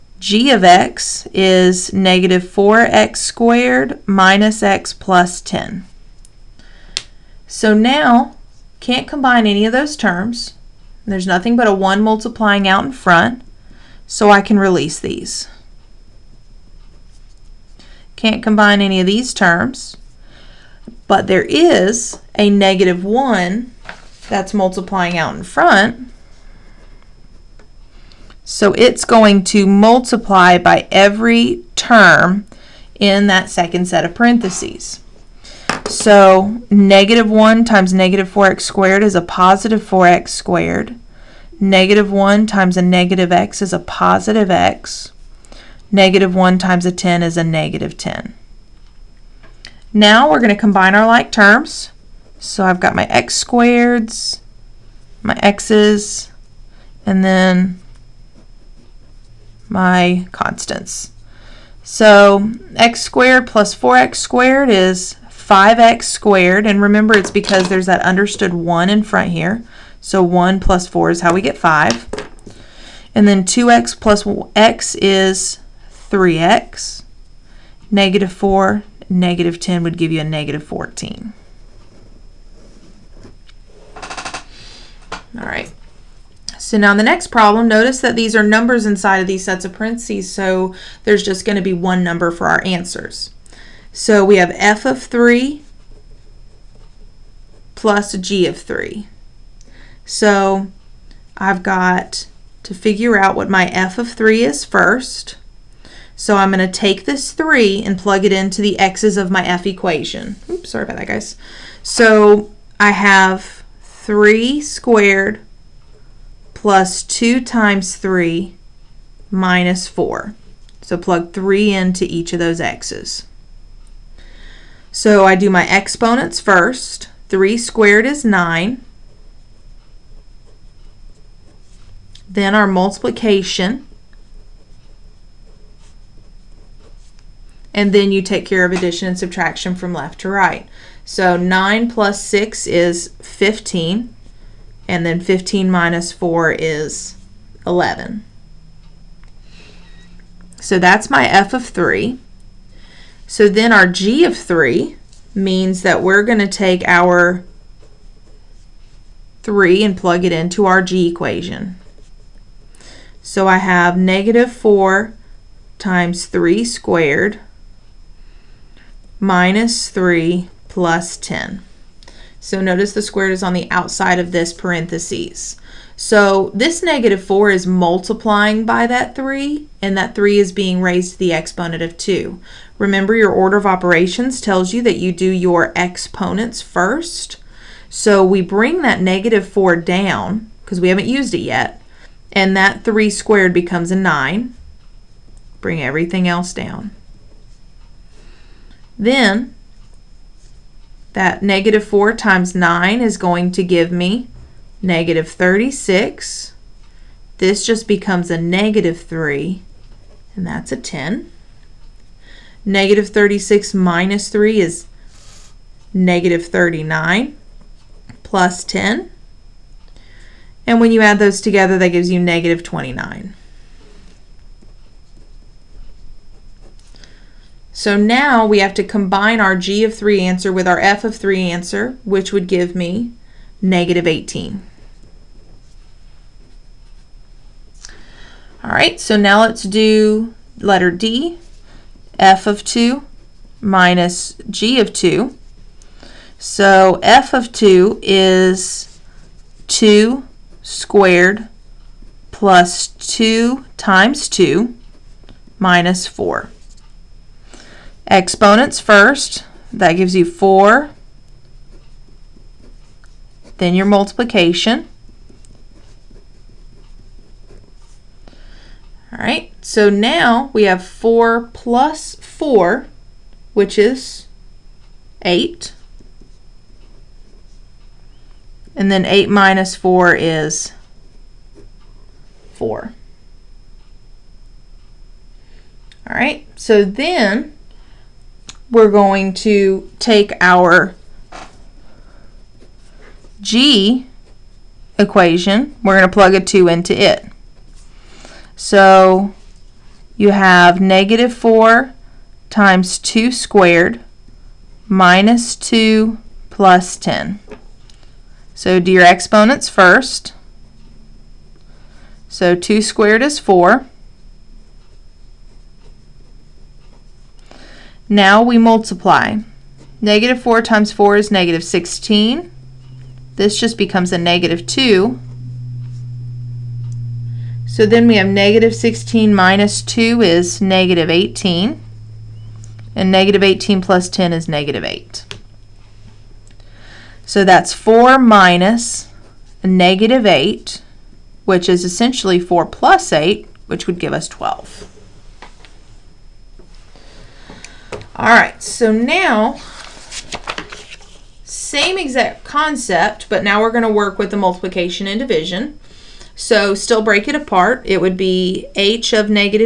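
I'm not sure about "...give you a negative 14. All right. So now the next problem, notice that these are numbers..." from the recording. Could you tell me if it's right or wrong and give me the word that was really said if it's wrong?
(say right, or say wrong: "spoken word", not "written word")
right.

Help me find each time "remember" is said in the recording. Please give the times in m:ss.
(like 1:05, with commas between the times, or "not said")
1:06, 3:02.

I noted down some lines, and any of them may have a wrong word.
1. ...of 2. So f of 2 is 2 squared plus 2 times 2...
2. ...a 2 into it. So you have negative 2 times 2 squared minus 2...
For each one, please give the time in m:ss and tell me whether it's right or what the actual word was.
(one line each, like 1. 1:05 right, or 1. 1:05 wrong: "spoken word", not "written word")
1. 4:04 right
2. 4:56 wrong: "4", not "2".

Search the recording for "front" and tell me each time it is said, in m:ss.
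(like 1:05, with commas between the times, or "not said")
0:12, 0:25, 1:09.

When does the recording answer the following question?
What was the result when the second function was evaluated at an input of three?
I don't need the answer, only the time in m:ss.
3:42.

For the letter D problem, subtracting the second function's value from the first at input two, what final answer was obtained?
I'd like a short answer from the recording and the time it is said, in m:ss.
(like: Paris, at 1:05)
12, at 5:44.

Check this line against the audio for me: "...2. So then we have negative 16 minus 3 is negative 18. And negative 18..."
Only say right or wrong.
wrong.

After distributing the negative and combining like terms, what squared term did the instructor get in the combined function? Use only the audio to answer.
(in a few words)
5x squared.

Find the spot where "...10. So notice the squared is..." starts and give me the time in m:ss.
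2:51.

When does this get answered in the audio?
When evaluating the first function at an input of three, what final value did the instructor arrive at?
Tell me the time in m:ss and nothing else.
2:27.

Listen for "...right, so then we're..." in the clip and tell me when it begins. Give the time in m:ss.
4:46.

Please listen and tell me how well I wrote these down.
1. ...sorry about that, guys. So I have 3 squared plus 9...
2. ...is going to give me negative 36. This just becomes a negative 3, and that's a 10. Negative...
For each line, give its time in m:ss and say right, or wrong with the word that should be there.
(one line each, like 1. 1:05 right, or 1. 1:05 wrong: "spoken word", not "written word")
1. 1:50 wrong: "2", not "9"
2. 3:23 right.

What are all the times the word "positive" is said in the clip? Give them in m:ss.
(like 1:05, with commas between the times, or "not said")
0:39, 0:43.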